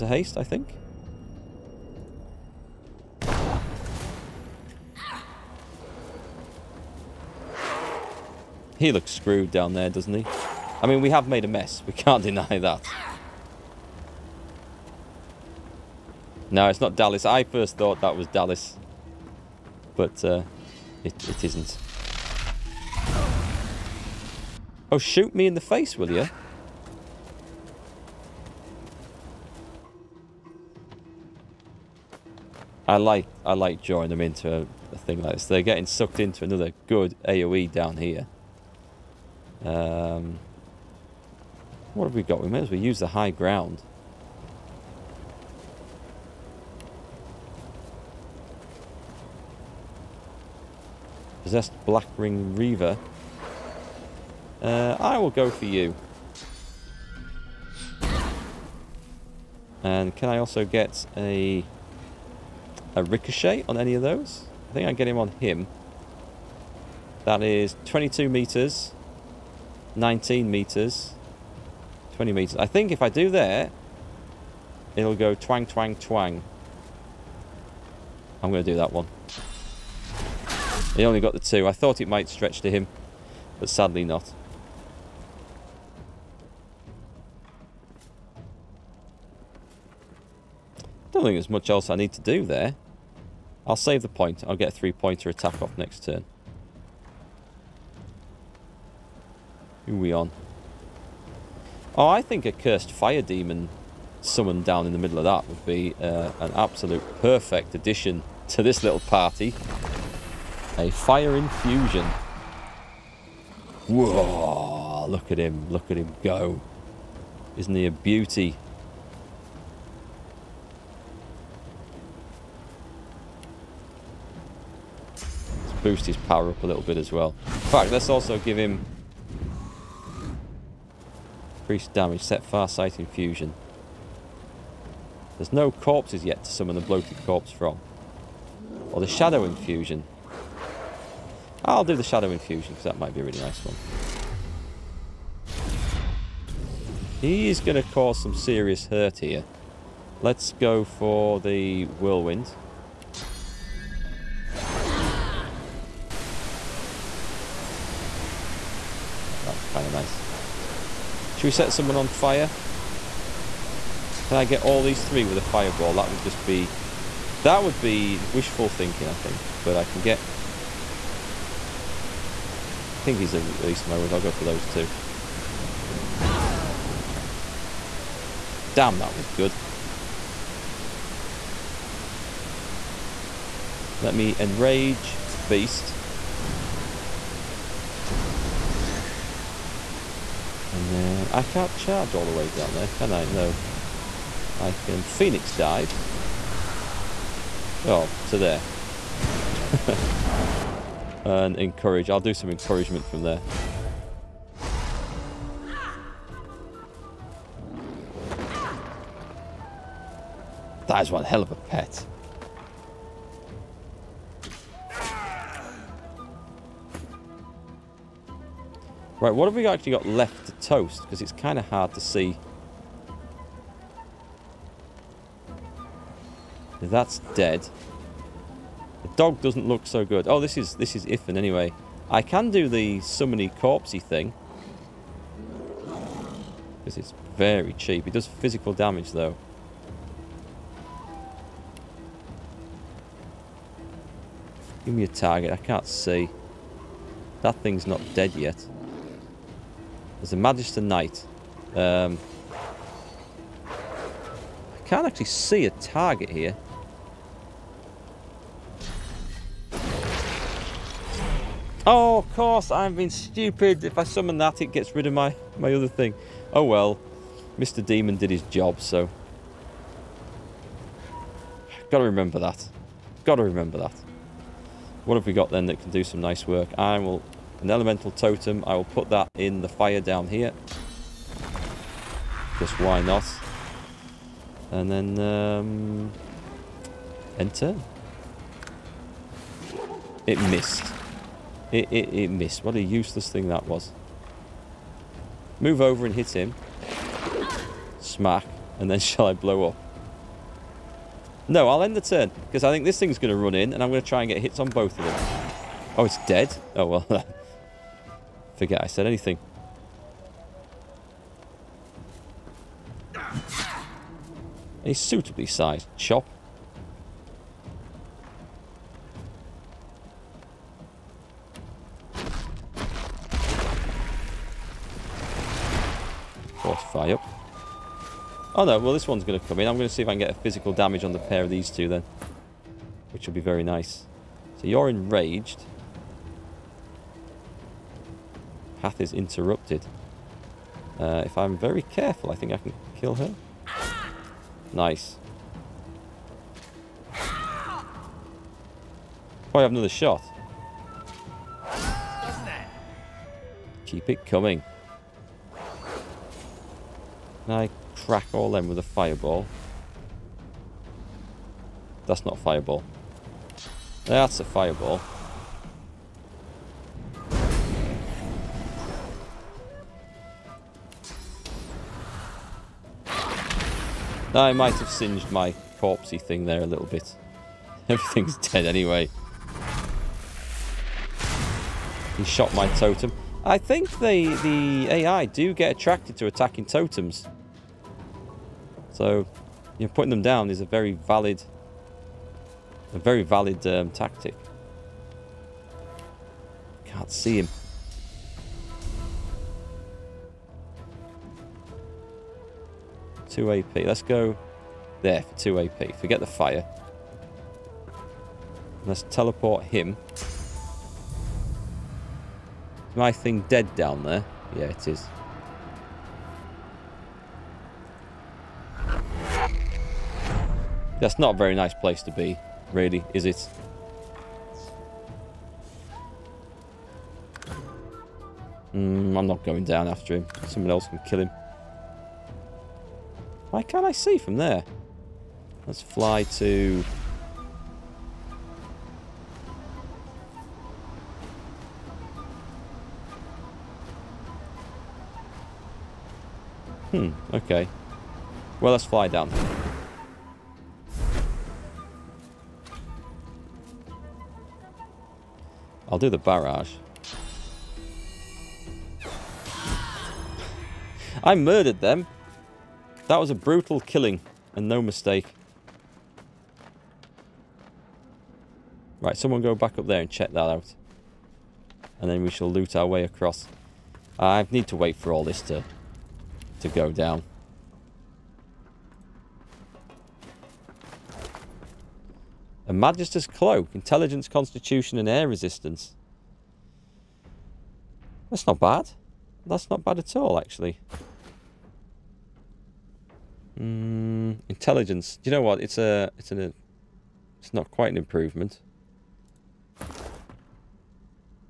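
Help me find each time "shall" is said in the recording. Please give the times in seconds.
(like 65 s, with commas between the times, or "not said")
298 s, 472 s.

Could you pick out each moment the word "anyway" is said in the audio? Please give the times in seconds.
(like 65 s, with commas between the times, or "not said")
231 s, 378 s.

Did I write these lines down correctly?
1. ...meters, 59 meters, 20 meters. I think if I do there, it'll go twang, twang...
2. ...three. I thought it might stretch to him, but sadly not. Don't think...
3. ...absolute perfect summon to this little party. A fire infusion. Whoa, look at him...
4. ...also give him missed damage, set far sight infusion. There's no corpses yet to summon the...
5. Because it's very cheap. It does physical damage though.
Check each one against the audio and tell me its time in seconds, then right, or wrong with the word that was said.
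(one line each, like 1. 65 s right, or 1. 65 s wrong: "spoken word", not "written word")
1. 68 s wrong: "19", not "59"
2. 81 s wrong: "two", not "three"
3. 106 s wrong: "addition", not "summon"
4. 128 s wrong: "increased", not "missed"
5. 236 s right.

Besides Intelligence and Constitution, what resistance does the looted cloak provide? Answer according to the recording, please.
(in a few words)
Air Resistance.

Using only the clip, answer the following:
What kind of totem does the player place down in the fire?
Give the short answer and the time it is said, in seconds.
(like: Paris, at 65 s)
elemental totem, at 277 s.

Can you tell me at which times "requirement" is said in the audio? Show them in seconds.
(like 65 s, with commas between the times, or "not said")
not said.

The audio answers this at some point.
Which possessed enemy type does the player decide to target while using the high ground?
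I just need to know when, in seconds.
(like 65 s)
51 s.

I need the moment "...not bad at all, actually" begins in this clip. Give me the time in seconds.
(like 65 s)
489 s.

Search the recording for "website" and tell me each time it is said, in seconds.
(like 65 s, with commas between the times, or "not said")
not said.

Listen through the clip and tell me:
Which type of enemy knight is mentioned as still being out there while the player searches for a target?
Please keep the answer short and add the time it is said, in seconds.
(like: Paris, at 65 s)
Magister Knight, at 250 s.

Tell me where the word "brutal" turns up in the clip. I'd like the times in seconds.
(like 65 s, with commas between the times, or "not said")
463 s.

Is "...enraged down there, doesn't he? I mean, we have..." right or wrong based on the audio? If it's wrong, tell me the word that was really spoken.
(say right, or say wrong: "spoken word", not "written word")
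wrong: "screwed", not "enraged".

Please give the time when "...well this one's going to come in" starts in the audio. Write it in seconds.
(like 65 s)
328 s.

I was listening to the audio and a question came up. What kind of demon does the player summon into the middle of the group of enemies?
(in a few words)
cursed fire demon.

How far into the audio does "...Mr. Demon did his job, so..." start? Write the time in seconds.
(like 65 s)
267 s.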